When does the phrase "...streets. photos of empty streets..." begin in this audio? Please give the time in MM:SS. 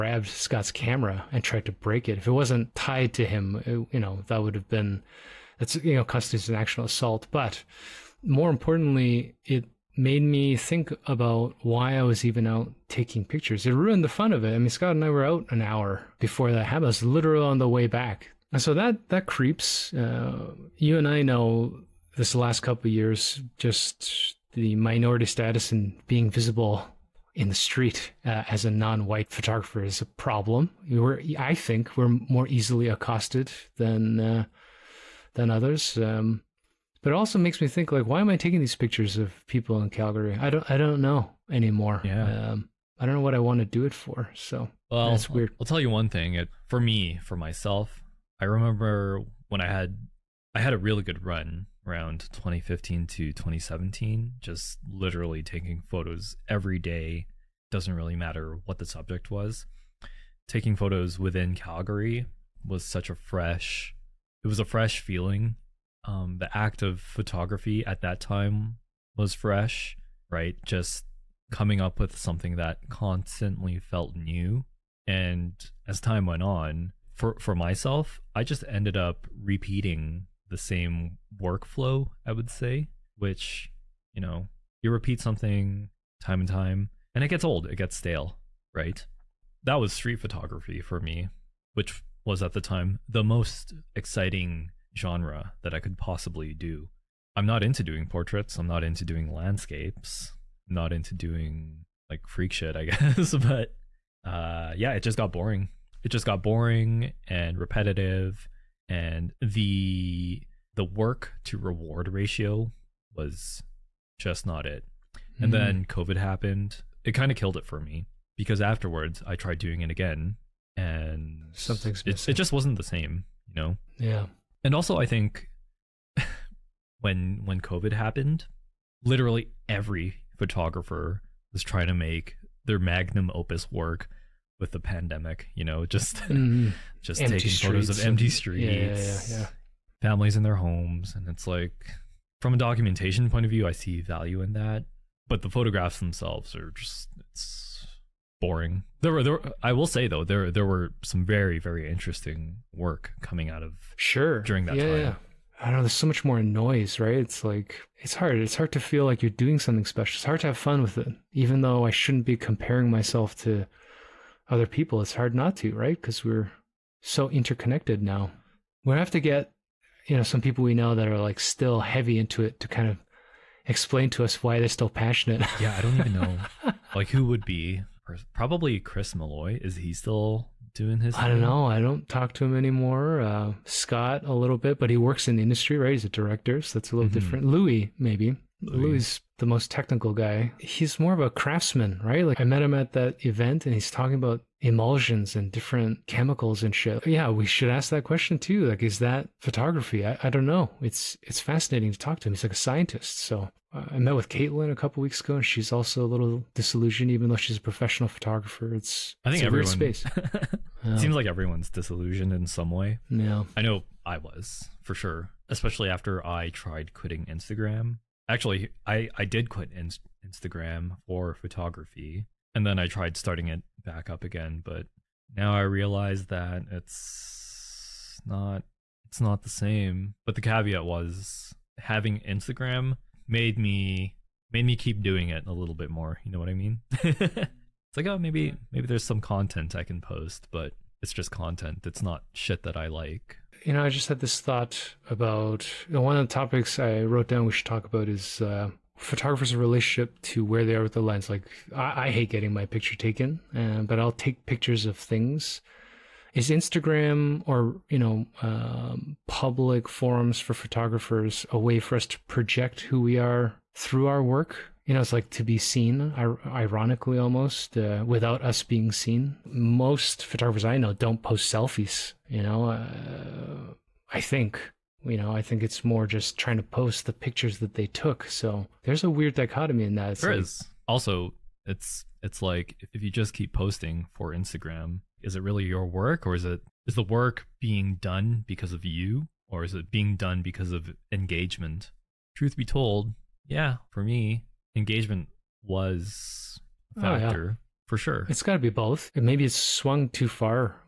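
02:17.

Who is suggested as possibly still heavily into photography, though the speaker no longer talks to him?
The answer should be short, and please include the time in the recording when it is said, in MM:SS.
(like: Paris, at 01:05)
Chris Malloy, at 02:58.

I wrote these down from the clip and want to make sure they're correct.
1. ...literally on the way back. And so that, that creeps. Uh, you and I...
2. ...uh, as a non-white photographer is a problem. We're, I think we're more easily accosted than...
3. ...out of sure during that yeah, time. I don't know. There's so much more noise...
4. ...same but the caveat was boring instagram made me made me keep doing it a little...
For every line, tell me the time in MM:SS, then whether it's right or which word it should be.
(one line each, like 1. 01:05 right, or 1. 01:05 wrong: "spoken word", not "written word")
1. 00:17 right
2. 00:28 right
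3. 02:33 right
4. 03:49 wrong: "having", not "boring".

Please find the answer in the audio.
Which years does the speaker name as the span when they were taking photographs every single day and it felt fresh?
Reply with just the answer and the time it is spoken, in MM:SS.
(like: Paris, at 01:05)
2015 to 2017, at 00:52.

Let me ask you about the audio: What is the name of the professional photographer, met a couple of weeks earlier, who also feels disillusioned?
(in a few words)
Caitlin.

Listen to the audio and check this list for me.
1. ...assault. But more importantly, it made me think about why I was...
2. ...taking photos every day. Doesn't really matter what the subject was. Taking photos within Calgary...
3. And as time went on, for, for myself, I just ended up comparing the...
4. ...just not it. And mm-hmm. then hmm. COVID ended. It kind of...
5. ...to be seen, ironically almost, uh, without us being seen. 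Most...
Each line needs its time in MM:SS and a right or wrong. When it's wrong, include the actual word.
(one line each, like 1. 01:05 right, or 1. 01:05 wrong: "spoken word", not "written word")
1. 00:06 right
2. 00:55 right
3. 01:15 wrong: "repeating", not "comparing"
4. 01:54 wrong: "happened", not "ended"
5. 04:25 right.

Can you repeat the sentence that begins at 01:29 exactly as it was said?
That was street photography for me, which was at the time the most exciting genre that I could possibly do.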